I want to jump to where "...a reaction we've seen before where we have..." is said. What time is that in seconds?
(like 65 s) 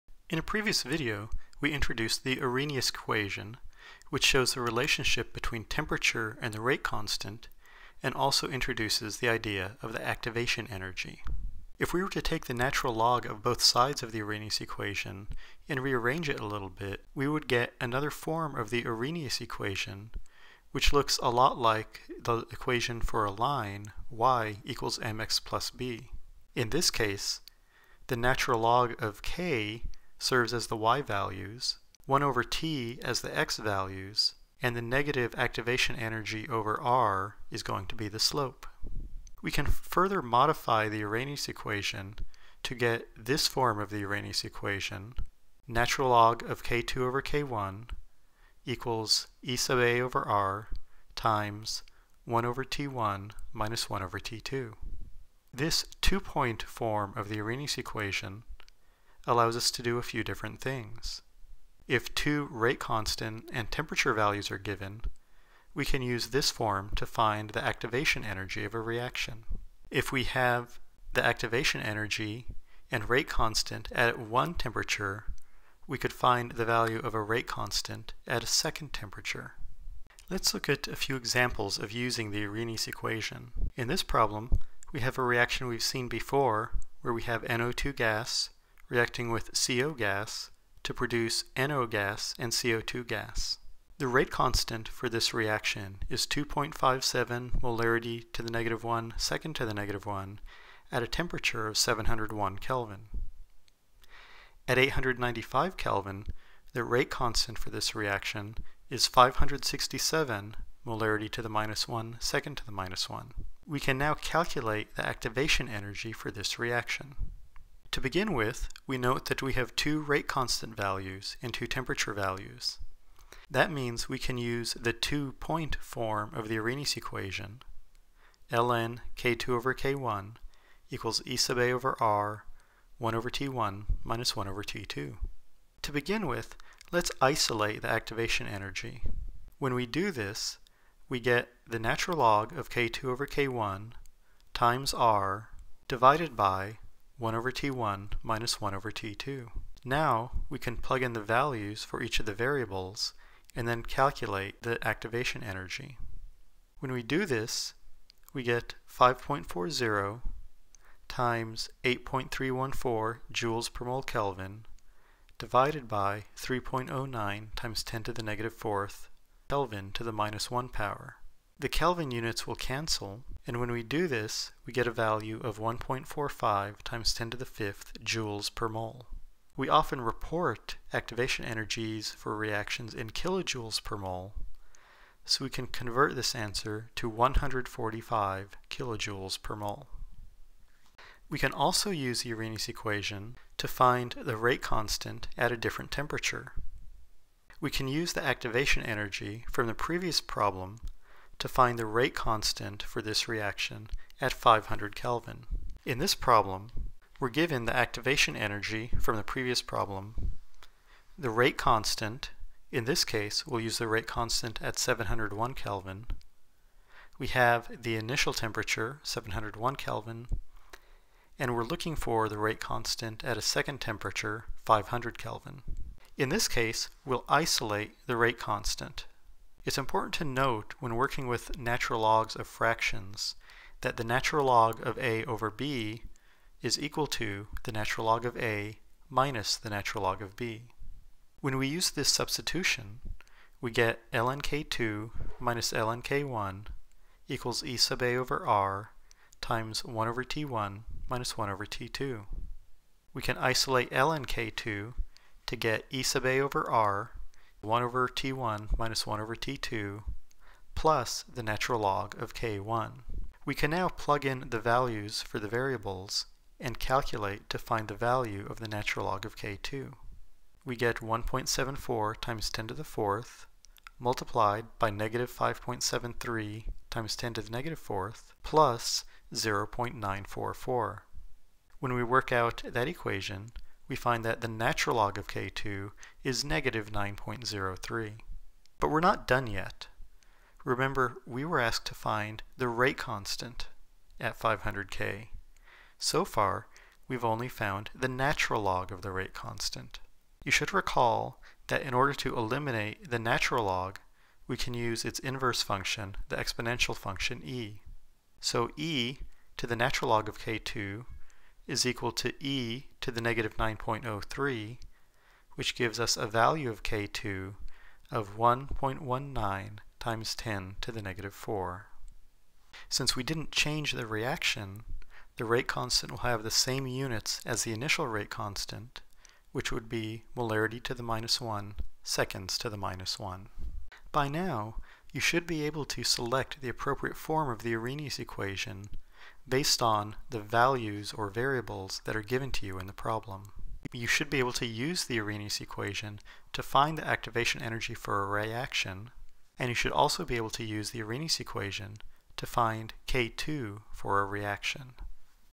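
85 s.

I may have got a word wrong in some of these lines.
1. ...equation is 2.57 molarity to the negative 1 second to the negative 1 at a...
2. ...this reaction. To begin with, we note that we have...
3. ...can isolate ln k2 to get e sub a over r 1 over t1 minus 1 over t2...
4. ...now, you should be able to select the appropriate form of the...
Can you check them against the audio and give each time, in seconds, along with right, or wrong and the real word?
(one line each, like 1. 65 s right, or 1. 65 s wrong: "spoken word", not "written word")
1. 95 s wrong: "reaction", not "equation"
2. 116 s right
3. 253 s right
4. 334 s right.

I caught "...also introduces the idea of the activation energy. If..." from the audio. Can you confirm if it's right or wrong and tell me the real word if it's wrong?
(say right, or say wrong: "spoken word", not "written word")
right.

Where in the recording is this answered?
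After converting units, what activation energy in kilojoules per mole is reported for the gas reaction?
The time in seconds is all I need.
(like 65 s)
187 s.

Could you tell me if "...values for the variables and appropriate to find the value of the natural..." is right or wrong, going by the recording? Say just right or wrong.
wrong.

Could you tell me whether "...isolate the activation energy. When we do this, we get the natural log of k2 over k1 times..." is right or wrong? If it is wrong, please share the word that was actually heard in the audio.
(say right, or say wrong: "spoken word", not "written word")
right.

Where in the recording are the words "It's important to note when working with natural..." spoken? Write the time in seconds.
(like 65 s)
229 s.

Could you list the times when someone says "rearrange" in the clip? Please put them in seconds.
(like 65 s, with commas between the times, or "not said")
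15 s.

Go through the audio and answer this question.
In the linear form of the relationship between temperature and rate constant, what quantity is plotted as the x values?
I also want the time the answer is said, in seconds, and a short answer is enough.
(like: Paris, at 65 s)
1 over T, at 32 s.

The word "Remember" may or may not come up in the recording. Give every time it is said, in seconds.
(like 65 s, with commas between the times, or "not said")
290 s.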